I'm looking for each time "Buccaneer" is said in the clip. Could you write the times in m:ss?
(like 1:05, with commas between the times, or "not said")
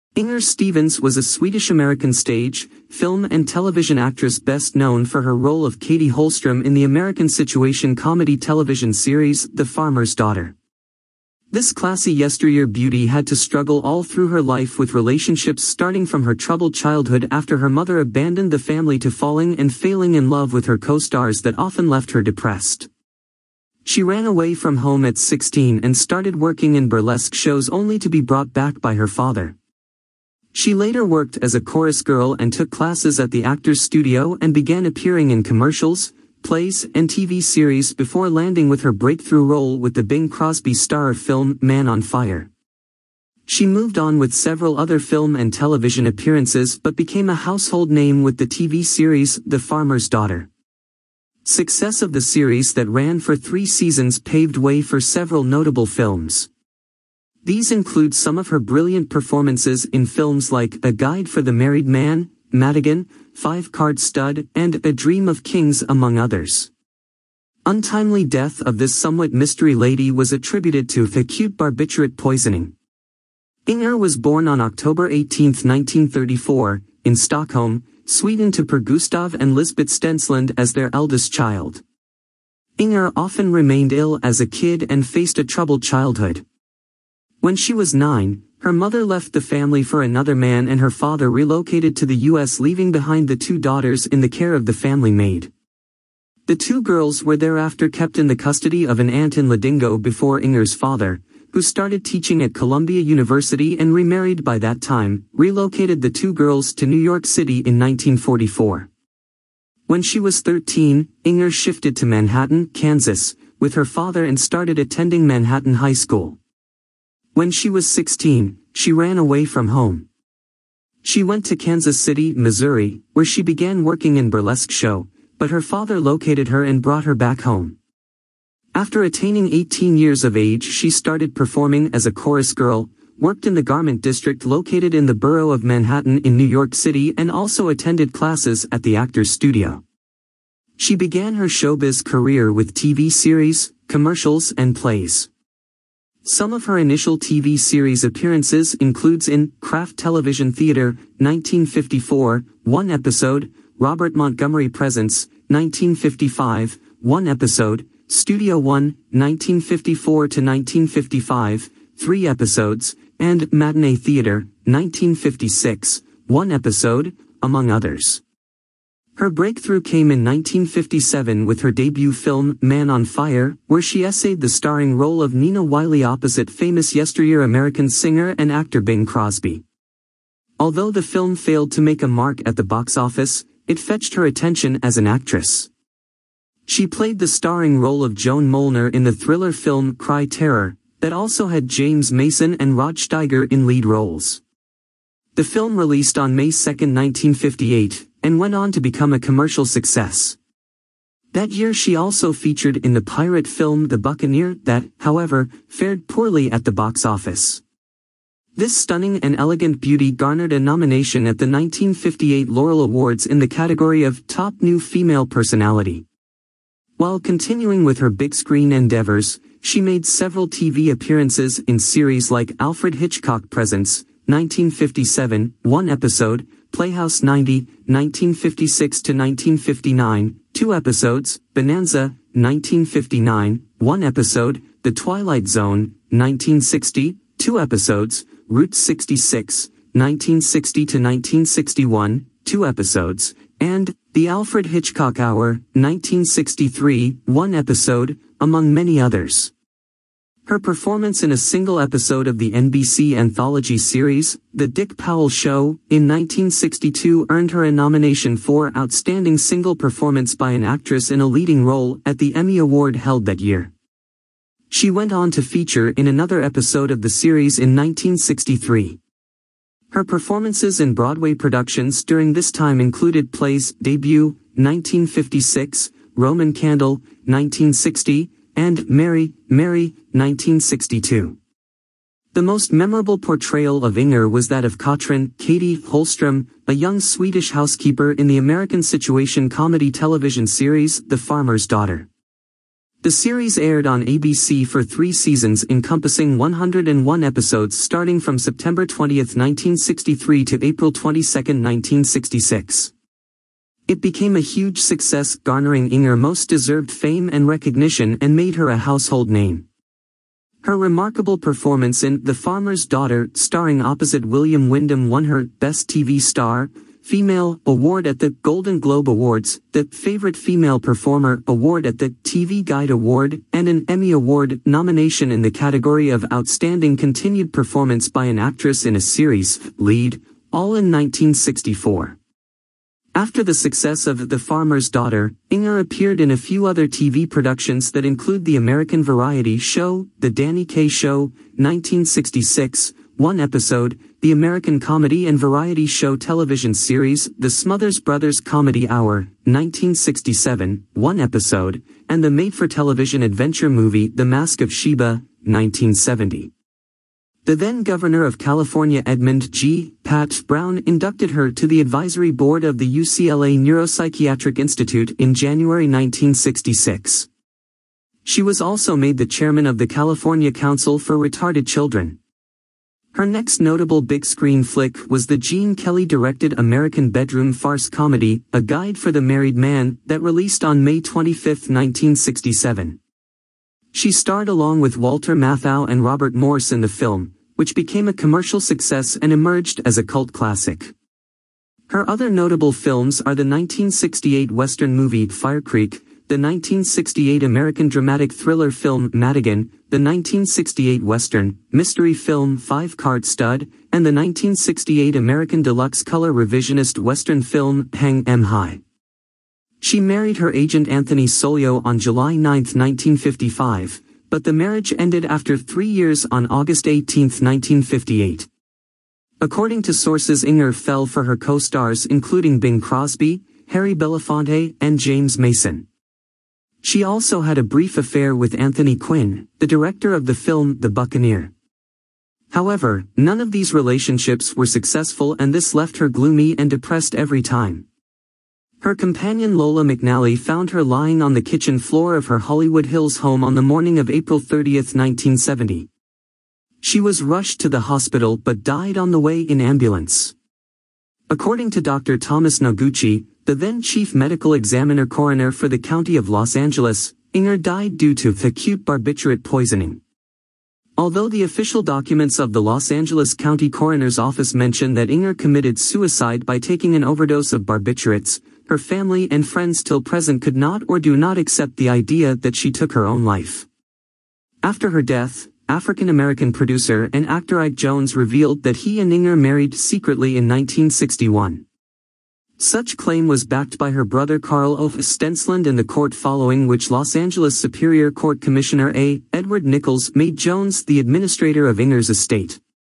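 3:23, 7:10.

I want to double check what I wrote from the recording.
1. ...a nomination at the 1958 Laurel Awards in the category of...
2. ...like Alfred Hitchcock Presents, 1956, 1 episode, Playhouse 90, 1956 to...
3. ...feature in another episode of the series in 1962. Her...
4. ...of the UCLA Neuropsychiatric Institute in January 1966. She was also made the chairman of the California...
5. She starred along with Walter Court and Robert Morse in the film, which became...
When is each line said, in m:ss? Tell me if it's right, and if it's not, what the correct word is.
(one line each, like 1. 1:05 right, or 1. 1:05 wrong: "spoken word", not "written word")
1. 3:30 right
2. 3:42 wrong: "1957", not "1956"
3. 4:25 wrong: "1963", not "1962"
4. 6:02 right
5. 6:23 wrong: "Matthau", not "Court".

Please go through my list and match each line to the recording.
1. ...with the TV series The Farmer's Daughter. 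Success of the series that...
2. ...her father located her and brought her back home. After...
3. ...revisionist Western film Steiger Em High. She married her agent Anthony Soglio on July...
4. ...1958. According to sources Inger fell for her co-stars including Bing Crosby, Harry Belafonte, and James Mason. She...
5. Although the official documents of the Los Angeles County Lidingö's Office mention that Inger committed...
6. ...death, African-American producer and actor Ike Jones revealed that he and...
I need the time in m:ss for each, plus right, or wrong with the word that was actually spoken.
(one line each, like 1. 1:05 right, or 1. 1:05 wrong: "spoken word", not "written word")
1. 0:48 right
2. 2:05 right
3. 6:46 wrong: "Hang", not "Steiger"
4. 6:57 right
5. 7:40 wrong: "Coroner", not "Lidingö"
6. 7:55 right.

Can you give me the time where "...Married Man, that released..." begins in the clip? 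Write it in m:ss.
6:19.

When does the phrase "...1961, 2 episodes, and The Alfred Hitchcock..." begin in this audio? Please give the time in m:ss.
4:00.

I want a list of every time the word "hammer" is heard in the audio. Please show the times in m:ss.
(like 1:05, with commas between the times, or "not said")
not said.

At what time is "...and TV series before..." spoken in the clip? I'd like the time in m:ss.
0:36.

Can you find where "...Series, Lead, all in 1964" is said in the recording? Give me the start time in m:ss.
5:29.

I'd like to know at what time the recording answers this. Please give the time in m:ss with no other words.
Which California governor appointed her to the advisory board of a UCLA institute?
5:59.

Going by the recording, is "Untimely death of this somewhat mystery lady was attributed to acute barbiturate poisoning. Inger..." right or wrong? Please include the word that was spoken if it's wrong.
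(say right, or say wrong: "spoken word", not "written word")
right.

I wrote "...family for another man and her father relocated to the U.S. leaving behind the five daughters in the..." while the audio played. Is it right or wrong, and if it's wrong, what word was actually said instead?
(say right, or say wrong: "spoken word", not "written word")
wrong: "two", not "five".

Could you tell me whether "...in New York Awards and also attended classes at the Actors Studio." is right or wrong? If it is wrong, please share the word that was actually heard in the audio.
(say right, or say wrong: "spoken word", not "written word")
wrong: "City", not "Awards".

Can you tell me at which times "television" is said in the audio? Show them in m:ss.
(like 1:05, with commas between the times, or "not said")
0:03, 0:08, 0:45, 2:29, 4:49, 5:46, 5:52.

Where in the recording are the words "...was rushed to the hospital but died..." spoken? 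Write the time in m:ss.
7:26.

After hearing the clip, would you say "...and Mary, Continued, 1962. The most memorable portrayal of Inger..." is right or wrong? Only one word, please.
wrong.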